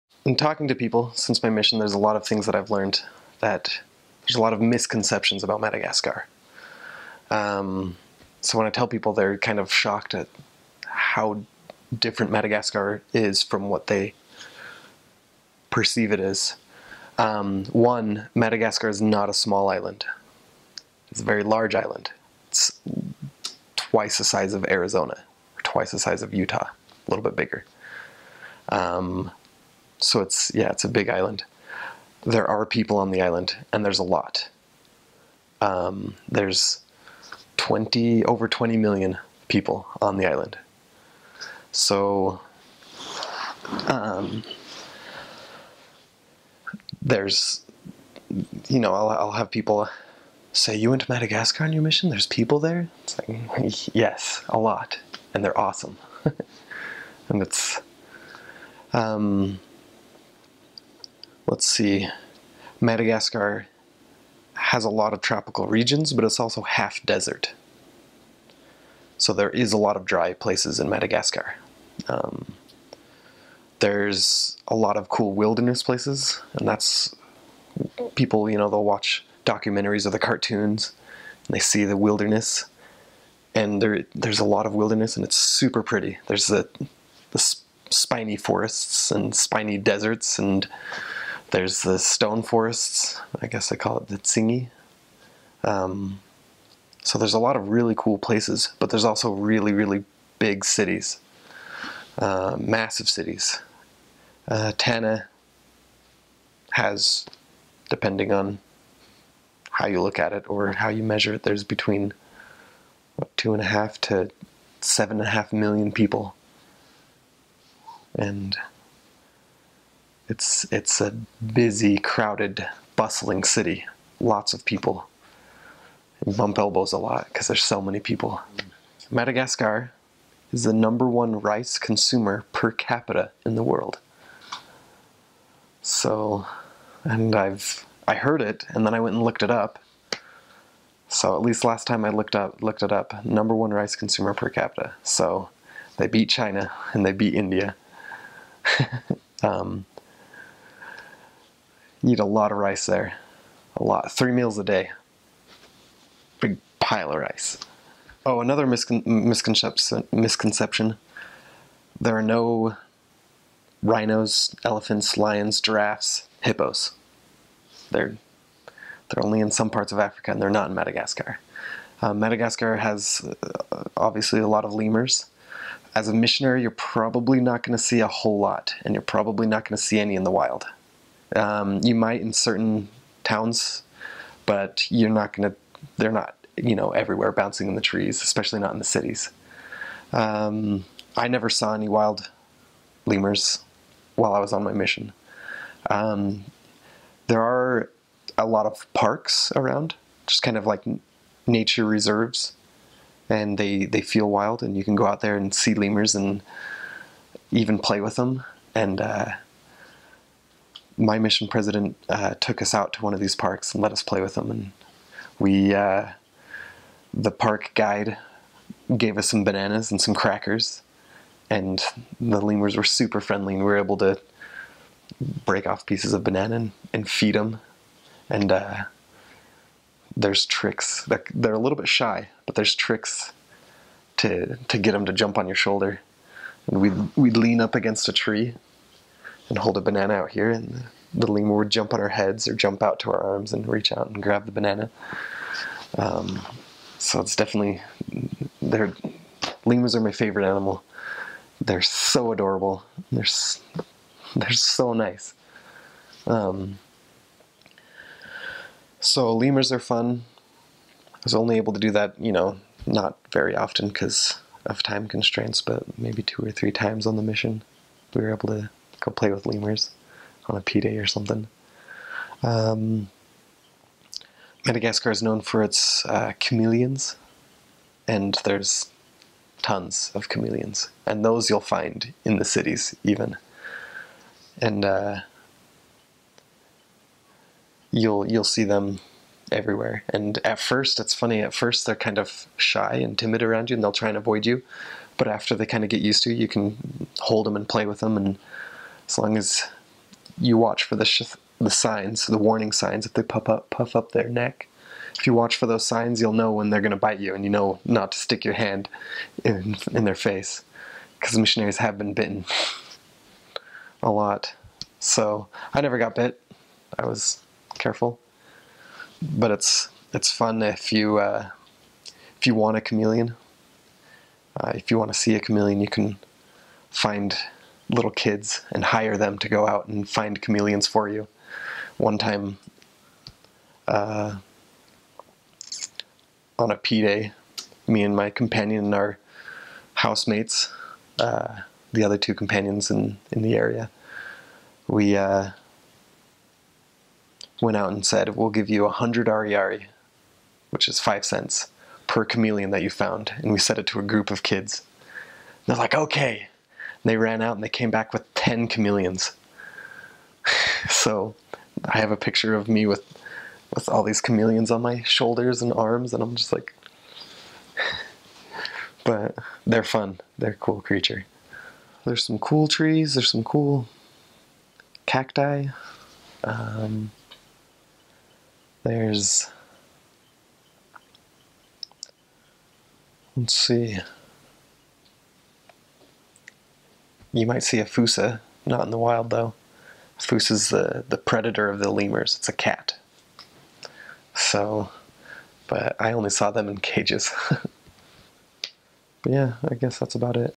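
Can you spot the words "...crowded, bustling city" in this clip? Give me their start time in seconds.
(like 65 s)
121 s.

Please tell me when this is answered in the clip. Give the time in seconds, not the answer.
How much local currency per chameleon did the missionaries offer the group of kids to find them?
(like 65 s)
348 s.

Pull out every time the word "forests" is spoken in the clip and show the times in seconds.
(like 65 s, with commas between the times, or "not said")
88 s, 92 s.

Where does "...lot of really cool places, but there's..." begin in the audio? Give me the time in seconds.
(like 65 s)
97 s.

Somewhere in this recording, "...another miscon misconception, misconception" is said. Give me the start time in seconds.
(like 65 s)
158 s.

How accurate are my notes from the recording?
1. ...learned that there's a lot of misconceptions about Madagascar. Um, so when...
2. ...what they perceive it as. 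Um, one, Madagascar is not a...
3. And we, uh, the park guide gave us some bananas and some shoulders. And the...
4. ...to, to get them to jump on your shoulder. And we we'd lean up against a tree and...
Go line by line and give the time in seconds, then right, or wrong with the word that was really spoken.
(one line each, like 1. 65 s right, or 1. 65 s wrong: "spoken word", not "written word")
1. 2 s right
2. 13 s right
3. 214 s wrong: "crackers", not "shoulders"
4. 234 s right.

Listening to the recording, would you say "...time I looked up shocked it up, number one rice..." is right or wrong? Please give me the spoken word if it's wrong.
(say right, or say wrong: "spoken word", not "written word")
wrong: "looked", not "shocked".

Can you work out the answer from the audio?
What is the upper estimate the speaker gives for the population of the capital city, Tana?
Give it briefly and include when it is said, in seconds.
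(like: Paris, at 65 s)
7.5 million, at 114 s.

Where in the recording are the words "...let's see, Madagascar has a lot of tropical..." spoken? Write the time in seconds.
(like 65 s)
61 s.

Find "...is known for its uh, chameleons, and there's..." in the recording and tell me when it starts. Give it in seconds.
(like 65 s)
275 s.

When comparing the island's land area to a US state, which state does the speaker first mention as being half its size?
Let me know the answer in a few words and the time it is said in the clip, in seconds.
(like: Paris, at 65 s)
Arizona, at 24 s.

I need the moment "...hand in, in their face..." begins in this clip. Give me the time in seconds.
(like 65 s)
308 s.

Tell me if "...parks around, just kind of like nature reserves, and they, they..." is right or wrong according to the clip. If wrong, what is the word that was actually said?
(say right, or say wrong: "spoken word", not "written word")
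right.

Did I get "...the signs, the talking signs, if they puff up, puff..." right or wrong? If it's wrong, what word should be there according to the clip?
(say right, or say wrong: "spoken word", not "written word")
wrong: "warning", not "talking".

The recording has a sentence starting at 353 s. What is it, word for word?
And we said it to a group of kids.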